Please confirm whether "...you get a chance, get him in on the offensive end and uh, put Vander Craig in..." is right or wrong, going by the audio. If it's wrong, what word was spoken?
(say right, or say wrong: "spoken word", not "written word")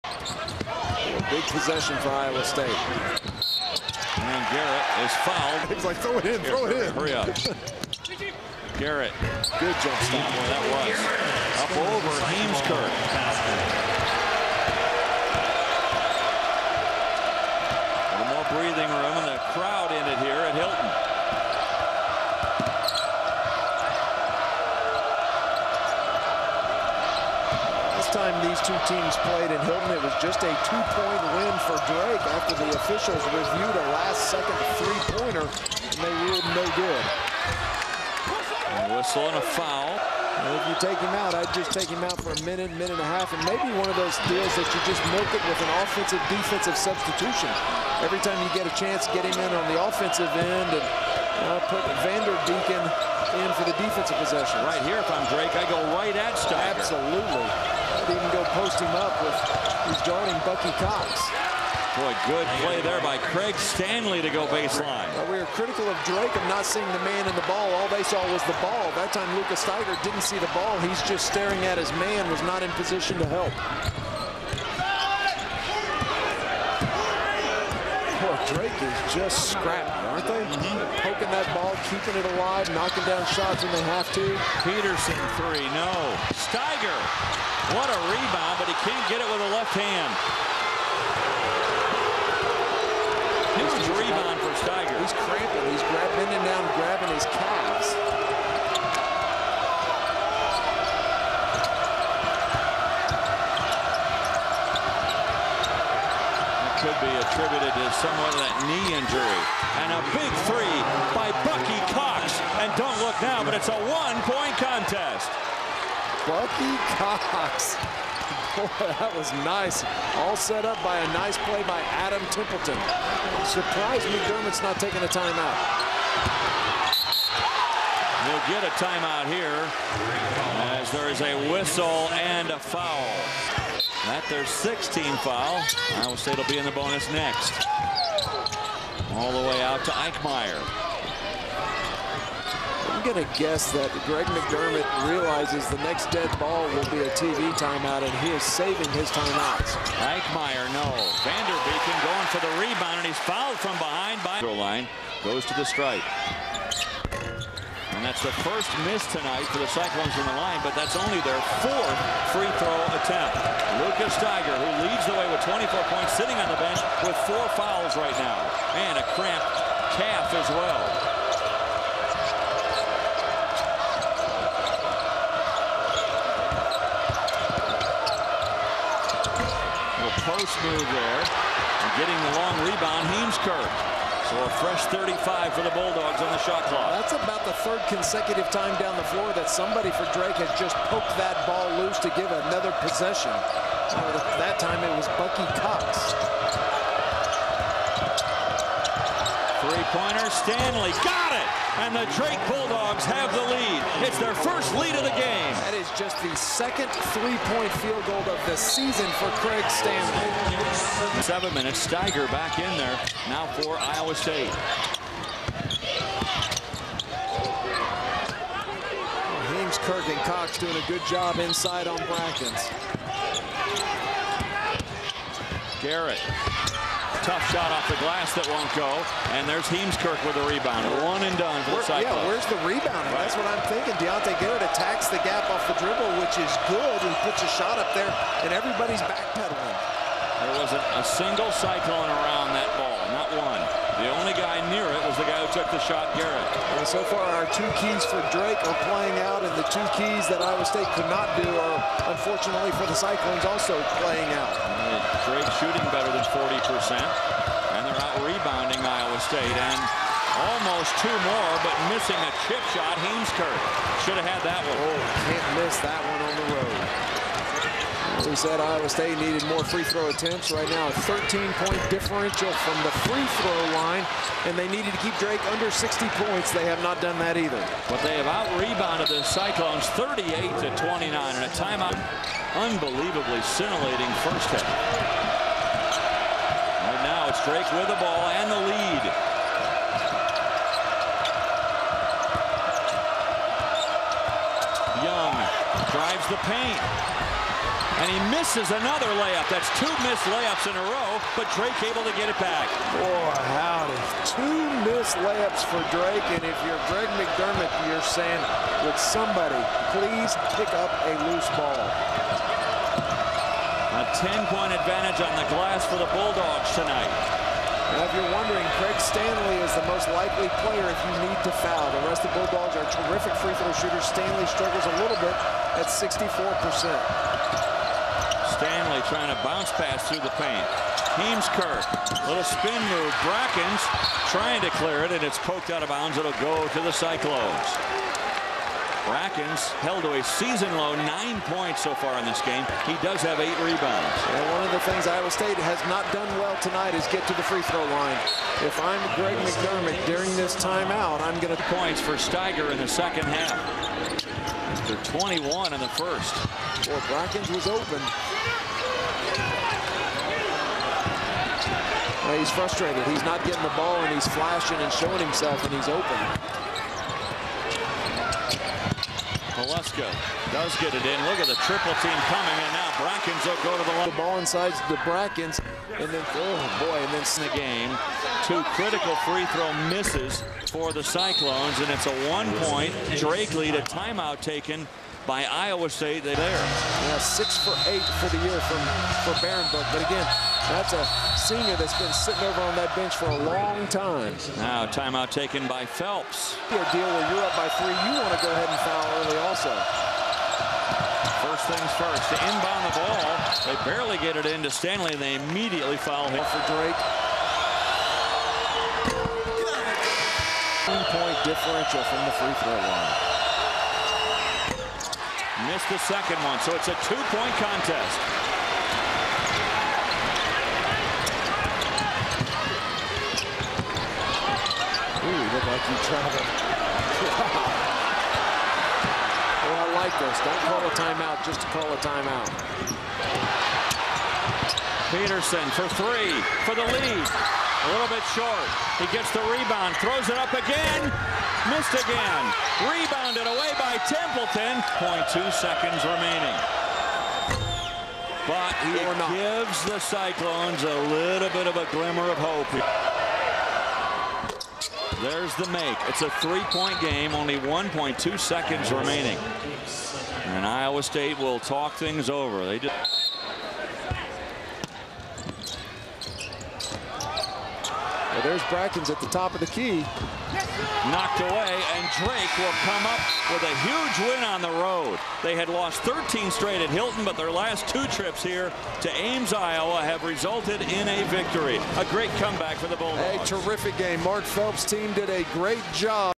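wrong: "Deacon", not "Craig".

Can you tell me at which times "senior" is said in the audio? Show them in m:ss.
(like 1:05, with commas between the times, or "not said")
6:31.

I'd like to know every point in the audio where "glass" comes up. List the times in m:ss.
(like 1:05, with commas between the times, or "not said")
3:48, 5:15.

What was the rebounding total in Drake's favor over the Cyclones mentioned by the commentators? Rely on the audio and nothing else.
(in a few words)
38 to 29.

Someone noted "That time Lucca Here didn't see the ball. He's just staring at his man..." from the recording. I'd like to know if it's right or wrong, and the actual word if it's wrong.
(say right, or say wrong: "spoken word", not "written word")
wrong: "Staiger", not "Here".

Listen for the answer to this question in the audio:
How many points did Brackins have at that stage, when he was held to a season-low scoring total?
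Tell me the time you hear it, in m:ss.
5:40.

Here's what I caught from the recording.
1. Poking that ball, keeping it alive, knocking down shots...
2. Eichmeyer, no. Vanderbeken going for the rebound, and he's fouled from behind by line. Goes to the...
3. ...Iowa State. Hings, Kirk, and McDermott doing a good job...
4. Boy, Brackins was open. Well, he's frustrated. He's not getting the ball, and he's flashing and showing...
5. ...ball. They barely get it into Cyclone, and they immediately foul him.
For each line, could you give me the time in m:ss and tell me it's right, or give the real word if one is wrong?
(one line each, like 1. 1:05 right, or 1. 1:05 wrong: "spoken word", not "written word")
1. 1:21 right
2. 2:30 right
3. 3:33 wrong: "Cox", not "McDermott"
4. 5:56 right
5. 6:42 wrong: "Stanley", not "Cyclone".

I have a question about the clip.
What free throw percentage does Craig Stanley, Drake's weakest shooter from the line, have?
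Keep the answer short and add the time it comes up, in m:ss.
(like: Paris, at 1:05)
64%, at 5:25.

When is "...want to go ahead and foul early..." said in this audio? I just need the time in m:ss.
6:38.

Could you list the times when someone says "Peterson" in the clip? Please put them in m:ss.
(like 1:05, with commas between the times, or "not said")
1:24, 7:15.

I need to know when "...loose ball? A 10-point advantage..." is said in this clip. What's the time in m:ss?
5:11.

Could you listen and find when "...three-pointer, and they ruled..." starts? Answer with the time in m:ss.
0:34.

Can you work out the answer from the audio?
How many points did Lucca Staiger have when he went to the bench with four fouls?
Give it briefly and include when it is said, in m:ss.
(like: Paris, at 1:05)
24, at 2:45.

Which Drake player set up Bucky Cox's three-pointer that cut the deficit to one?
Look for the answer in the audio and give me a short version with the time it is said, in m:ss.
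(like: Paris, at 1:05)
Adam Templeton, at 2:02.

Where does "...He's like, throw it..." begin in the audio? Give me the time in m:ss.
0:05.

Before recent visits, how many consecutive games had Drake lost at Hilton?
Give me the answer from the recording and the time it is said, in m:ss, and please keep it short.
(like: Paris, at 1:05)
13, at 7:56.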